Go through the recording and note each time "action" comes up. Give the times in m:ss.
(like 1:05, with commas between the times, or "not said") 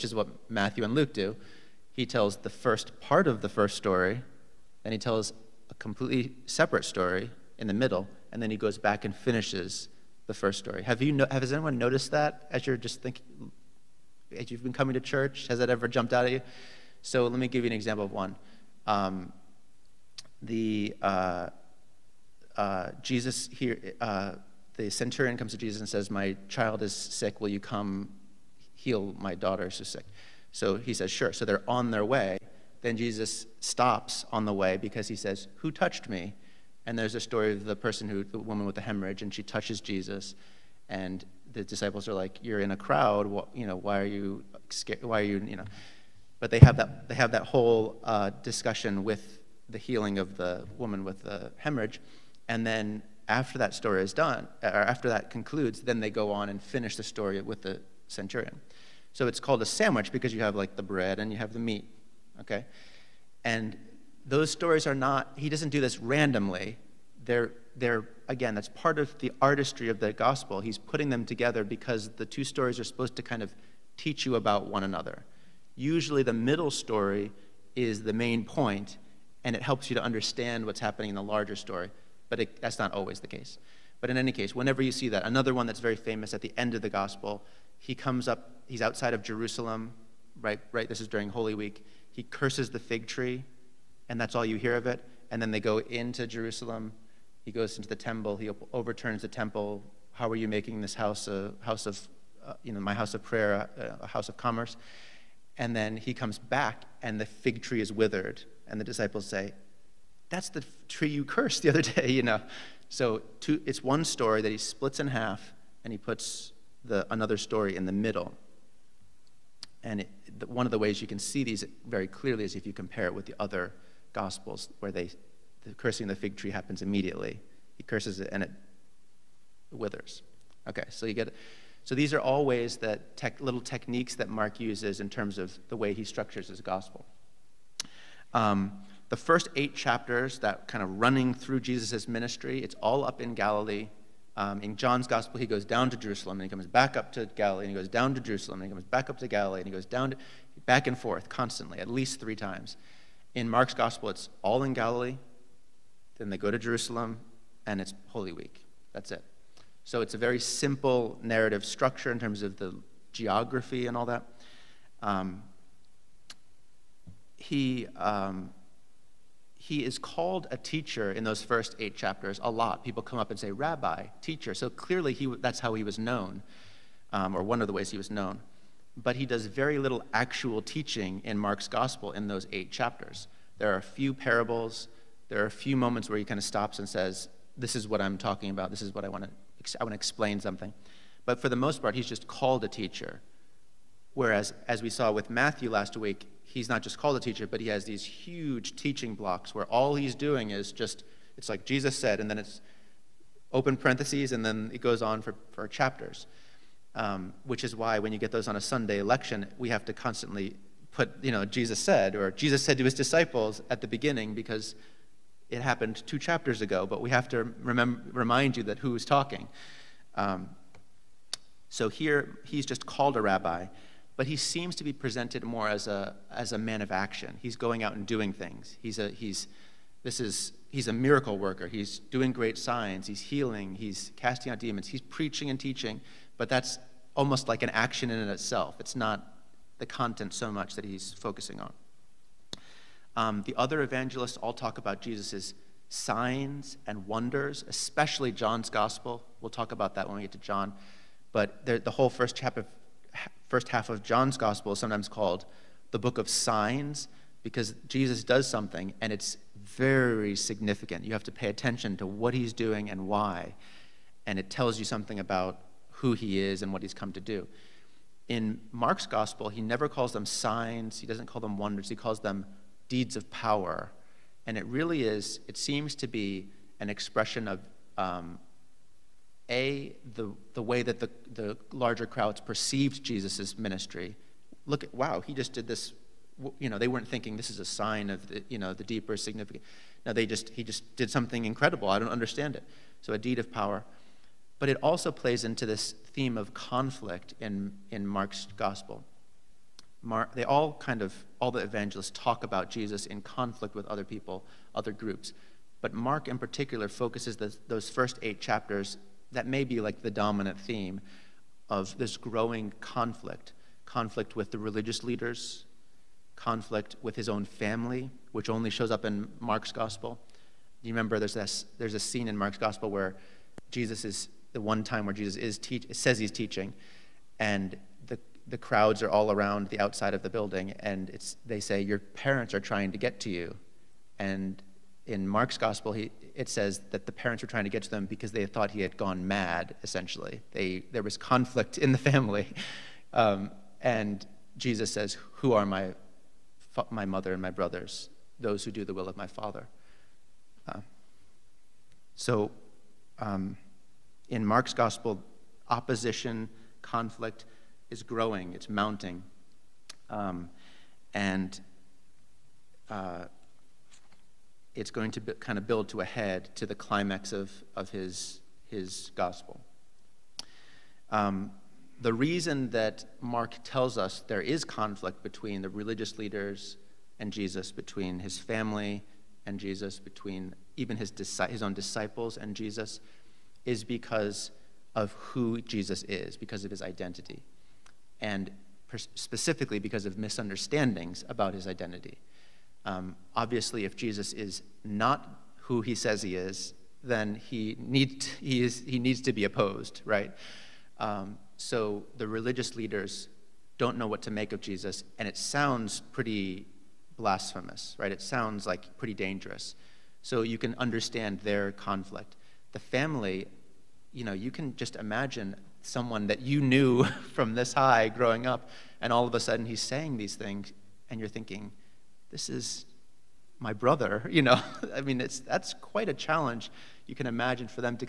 3:46, 3:57.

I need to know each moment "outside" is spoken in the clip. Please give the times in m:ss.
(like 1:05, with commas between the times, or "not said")
1:28, 5:29.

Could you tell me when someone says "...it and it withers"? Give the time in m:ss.
2:08.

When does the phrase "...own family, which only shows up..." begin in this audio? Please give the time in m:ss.
5:17.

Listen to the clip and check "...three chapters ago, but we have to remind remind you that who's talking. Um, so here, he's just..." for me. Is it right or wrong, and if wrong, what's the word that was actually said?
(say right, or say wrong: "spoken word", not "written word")
wrong: "two", not "three".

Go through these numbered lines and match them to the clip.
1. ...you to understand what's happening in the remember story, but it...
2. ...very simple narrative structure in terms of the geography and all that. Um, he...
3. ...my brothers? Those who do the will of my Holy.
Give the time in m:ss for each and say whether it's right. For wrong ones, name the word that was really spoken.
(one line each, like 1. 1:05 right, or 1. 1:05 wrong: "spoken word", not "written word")
1. 1:19 wrong: "larger", not "remember"
2. 2:40 right
3. 5:47 wrong: "Father", not "Holy".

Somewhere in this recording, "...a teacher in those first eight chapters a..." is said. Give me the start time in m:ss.
2:50.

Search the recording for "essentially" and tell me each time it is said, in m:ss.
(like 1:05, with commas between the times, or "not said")
5:39.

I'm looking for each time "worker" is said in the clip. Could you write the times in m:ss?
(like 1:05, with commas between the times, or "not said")
3:51.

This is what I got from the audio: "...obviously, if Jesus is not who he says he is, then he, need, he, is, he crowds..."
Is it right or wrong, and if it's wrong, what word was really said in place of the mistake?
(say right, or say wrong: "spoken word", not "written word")
wrong: "needs", not "crowds".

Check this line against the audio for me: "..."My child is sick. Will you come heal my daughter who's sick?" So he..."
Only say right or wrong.
right.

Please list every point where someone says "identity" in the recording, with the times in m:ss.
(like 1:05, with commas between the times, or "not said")
6:26, 6:31.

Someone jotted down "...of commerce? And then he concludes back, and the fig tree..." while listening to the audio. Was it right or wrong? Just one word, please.
wrong.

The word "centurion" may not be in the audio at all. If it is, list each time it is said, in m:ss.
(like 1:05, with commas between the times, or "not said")
0:24, 0:58.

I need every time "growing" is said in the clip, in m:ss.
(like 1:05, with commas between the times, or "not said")
5:12, 5:58, 6:58.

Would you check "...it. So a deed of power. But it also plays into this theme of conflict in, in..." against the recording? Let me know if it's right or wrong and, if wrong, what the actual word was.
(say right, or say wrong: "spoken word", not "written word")
right.